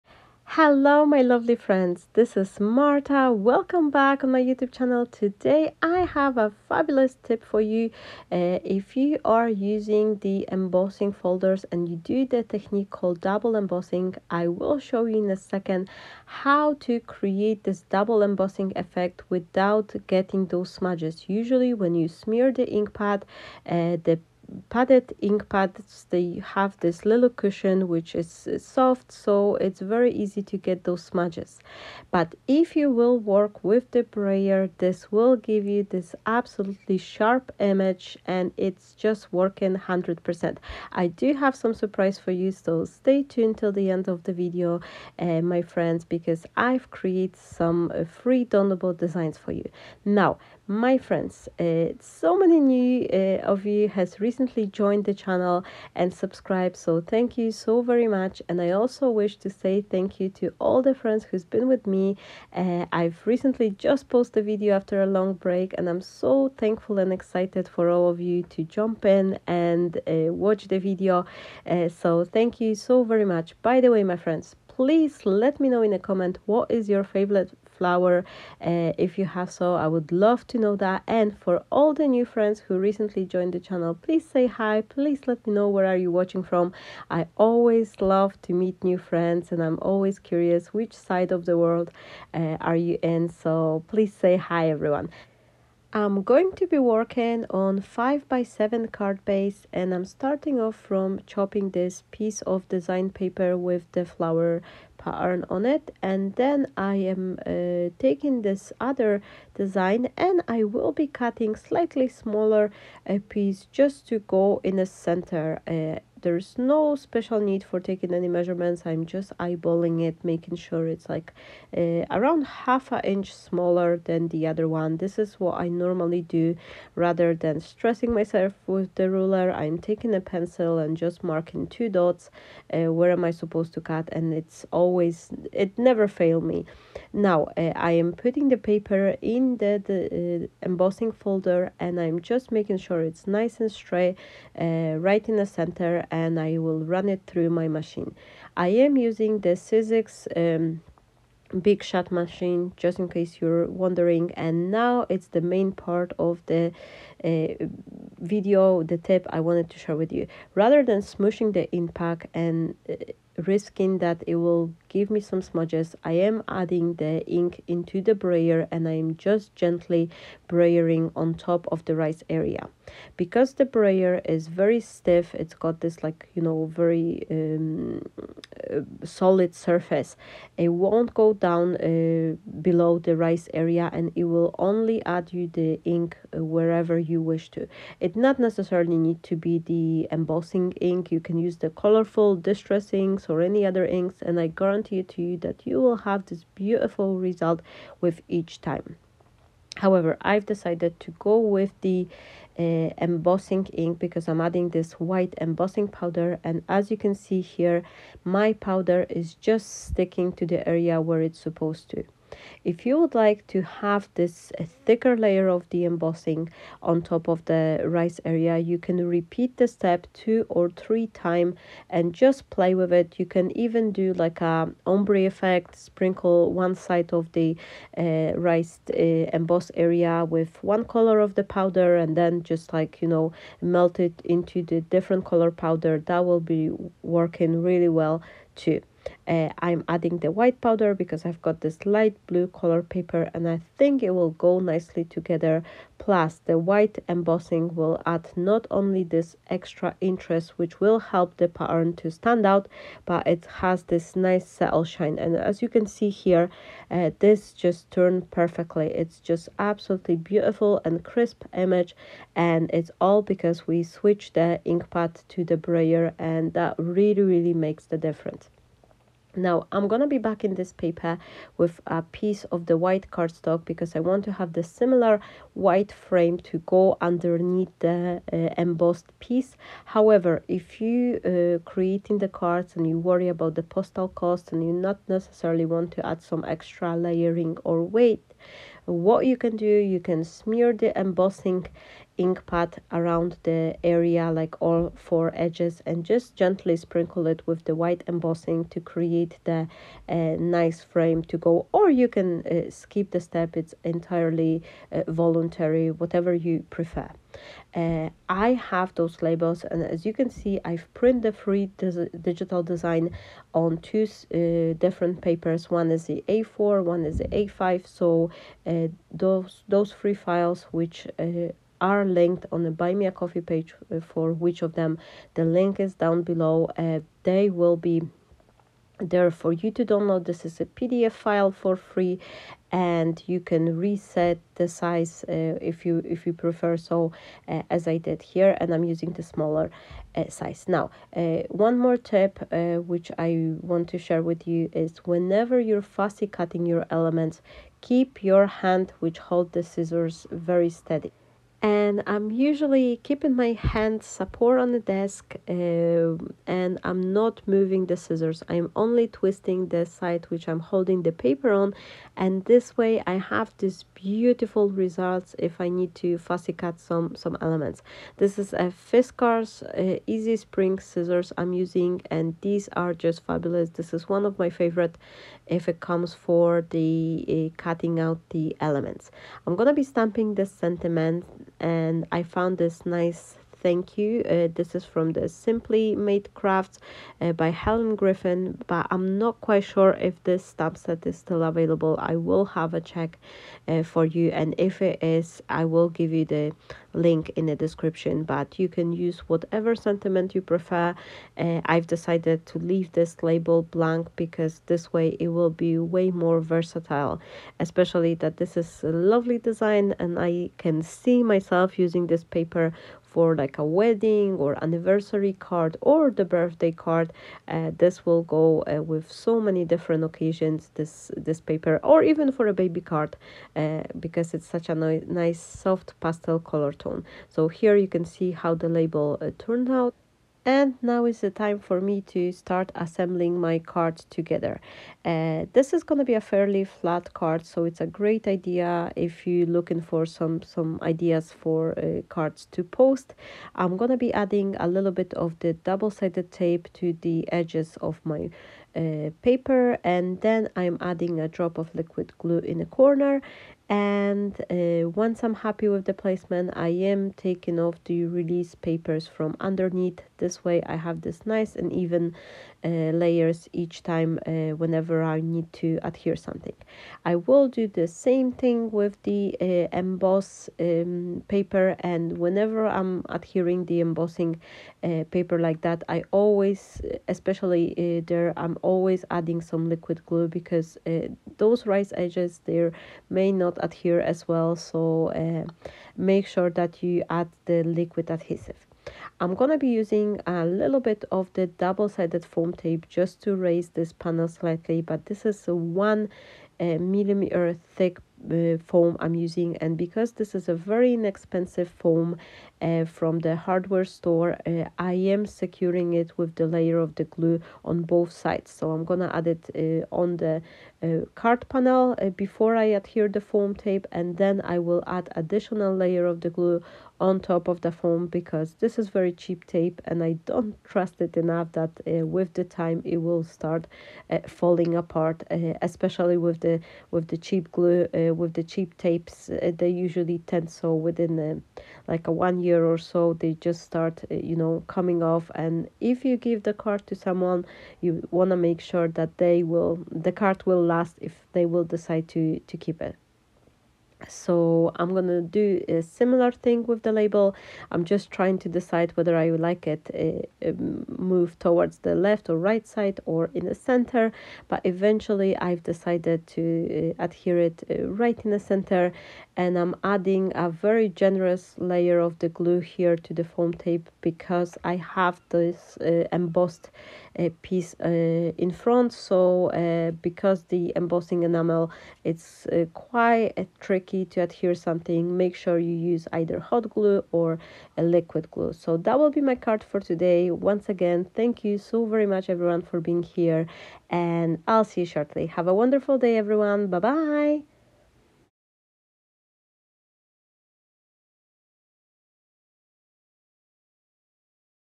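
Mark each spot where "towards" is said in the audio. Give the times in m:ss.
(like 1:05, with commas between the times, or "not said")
9:11.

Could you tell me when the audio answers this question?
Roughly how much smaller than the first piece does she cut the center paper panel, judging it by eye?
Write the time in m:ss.
2:02.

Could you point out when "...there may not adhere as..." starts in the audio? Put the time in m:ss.
8:02.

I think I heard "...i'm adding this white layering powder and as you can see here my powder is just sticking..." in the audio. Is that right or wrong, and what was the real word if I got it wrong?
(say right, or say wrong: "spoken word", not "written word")
wrong: "embossing", not "layering".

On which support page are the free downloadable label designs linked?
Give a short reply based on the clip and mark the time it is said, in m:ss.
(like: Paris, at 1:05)
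Buy Me a Coffee, at 5:22.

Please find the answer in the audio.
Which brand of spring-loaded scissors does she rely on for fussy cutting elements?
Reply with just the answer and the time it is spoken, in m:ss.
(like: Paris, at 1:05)
Fiskars, at 6:08.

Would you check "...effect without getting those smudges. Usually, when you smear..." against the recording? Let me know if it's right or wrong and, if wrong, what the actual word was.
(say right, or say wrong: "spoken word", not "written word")
right.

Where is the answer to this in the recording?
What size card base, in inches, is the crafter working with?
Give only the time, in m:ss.
1:37.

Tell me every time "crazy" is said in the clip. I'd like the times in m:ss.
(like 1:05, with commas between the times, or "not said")
not said.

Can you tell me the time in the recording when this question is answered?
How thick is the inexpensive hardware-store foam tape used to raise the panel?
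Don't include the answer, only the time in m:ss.
8:15.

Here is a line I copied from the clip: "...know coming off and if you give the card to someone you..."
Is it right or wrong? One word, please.
right.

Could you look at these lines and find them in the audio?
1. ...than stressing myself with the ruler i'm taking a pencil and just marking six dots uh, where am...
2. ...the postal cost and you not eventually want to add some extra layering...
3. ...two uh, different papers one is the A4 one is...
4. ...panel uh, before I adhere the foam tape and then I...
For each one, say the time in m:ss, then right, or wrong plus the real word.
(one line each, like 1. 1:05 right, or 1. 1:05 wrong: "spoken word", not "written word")
1. 2:07 wrong: "two", not "six"
2. 4:43 wrong: "necessarily", not "eventually"
3. 5:13 right
4. 8:31 right.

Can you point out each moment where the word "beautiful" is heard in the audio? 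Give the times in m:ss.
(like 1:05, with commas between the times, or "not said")
3:16, 4:20, 6:03.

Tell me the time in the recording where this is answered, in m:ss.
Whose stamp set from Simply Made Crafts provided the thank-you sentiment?
6:27.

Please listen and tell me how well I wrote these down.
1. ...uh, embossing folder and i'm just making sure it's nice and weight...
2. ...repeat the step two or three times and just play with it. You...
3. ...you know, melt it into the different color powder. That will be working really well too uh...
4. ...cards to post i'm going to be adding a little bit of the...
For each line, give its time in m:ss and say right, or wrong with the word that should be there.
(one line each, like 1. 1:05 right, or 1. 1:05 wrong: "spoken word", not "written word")
1. 2:20 wrong: "straight", not "weight"
2. 3:39 right
3. 3:53 right
4. 7:22 right.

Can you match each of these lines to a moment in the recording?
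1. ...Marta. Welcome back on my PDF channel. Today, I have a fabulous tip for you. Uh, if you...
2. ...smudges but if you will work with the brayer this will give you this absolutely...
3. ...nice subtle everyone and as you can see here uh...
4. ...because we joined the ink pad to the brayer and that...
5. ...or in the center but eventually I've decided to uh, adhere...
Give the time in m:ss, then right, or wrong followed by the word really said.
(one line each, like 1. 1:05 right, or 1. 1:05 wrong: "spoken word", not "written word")
1. 0:02 wrong: "YouTube", not "PDF"
2. 0:31 right
3. 4:14 wrong: "shine", not "everyone"
4. 4:23 wrong: "switched", not "joined"
5. 9:13 right.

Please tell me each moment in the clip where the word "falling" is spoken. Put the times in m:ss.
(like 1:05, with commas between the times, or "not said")
8:44.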